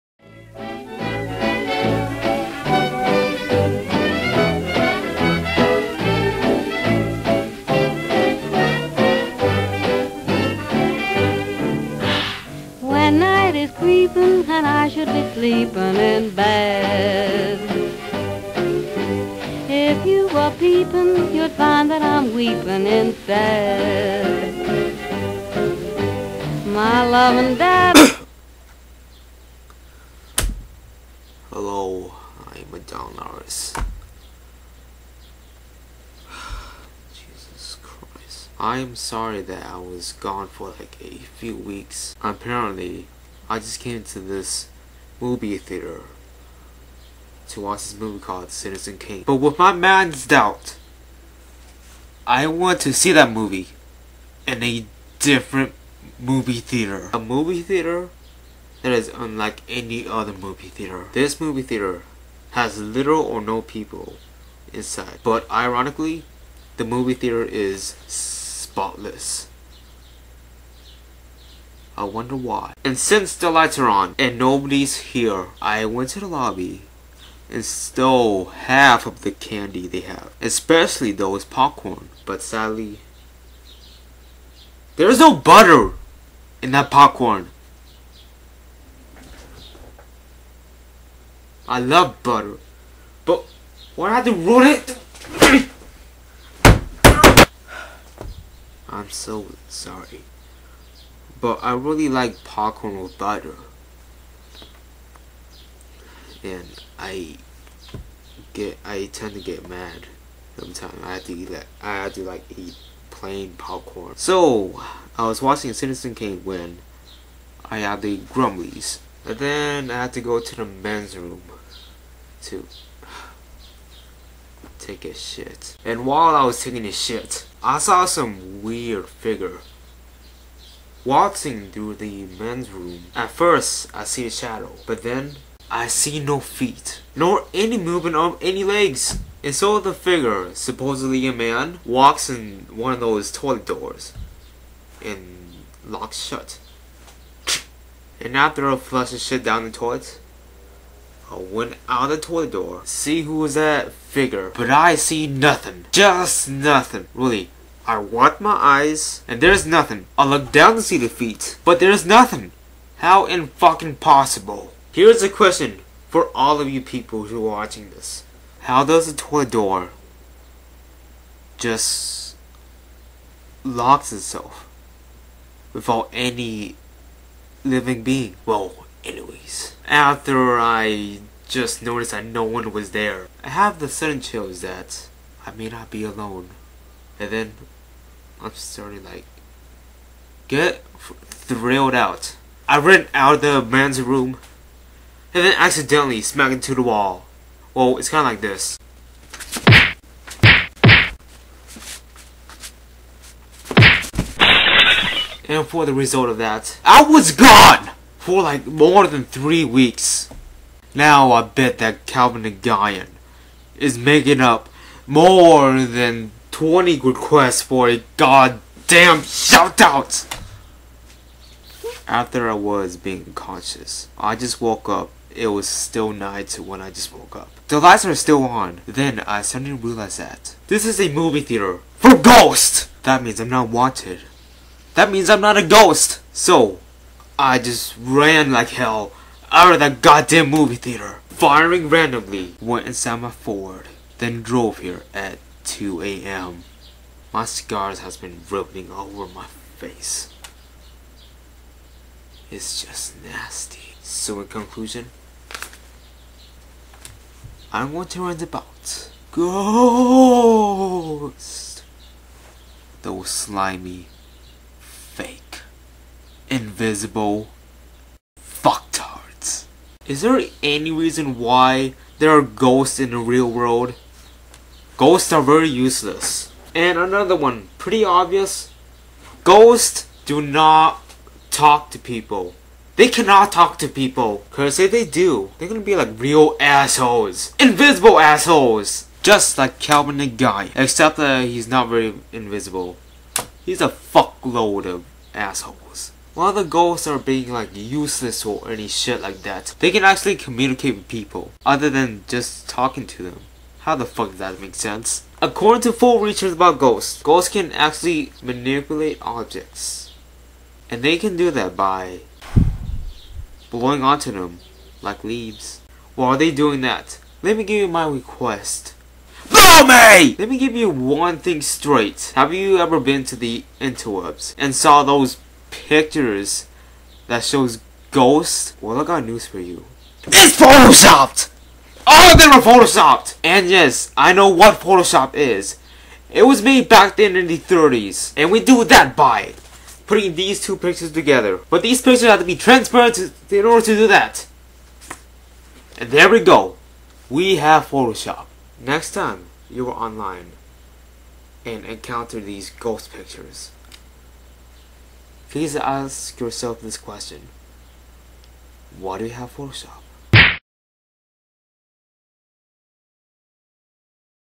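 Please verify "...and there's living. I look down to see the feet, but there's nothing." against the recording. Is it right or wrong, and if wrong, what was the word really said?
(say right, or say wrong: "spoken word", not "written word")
wrong: "nothing", not "living".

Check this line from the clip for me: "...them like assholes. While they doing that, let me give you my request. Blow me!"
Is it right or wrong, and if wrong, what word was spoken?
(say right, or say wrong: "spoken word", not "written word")
wrong: "leaves", not "assholes".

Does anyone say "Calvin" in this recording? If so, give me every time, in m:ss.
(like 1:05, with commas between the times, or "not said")
3:32, 4:49.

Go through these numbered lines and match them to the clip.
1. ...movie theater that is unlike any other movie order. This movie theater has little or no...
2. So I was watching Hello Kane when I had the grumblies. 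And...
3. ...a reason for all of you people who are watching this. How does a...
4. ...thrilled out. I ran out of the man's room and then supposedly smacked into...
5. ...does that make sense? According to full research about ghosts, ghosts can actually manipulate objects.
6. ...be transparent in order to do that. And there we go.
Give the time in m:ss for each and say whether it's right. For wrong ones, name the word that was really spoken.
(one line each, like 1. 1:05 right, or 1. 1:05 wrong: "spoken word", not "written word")
1. 0:57 wrong: "theater", not "order"
2. 1:54 wrong: "Citizen", not "Hello"
3. 2:45 wrong: "question", not "reason"
4. 3:11 wrong: "accidentally", not "supposedly"
5. 5:04 right
6. 5:42 right.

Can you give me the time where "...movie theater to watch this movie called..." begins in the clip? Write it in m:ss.
0:45.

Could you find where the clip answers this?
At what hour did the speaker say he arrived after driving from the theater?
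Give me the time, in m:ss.
4:05.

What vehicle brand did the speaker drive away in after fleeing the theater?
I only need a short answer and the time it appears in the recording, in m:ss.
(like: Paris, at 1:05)
Ford, at 4:03.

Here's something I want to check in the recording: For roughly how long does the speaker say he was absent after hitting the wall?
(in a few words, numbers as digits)
more than three weeks.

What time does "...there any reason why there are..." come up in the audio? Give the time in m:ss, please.
4:30.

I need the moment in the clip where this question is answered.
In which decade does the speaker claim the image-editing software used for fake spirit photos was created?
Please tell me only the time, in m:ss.
5:37.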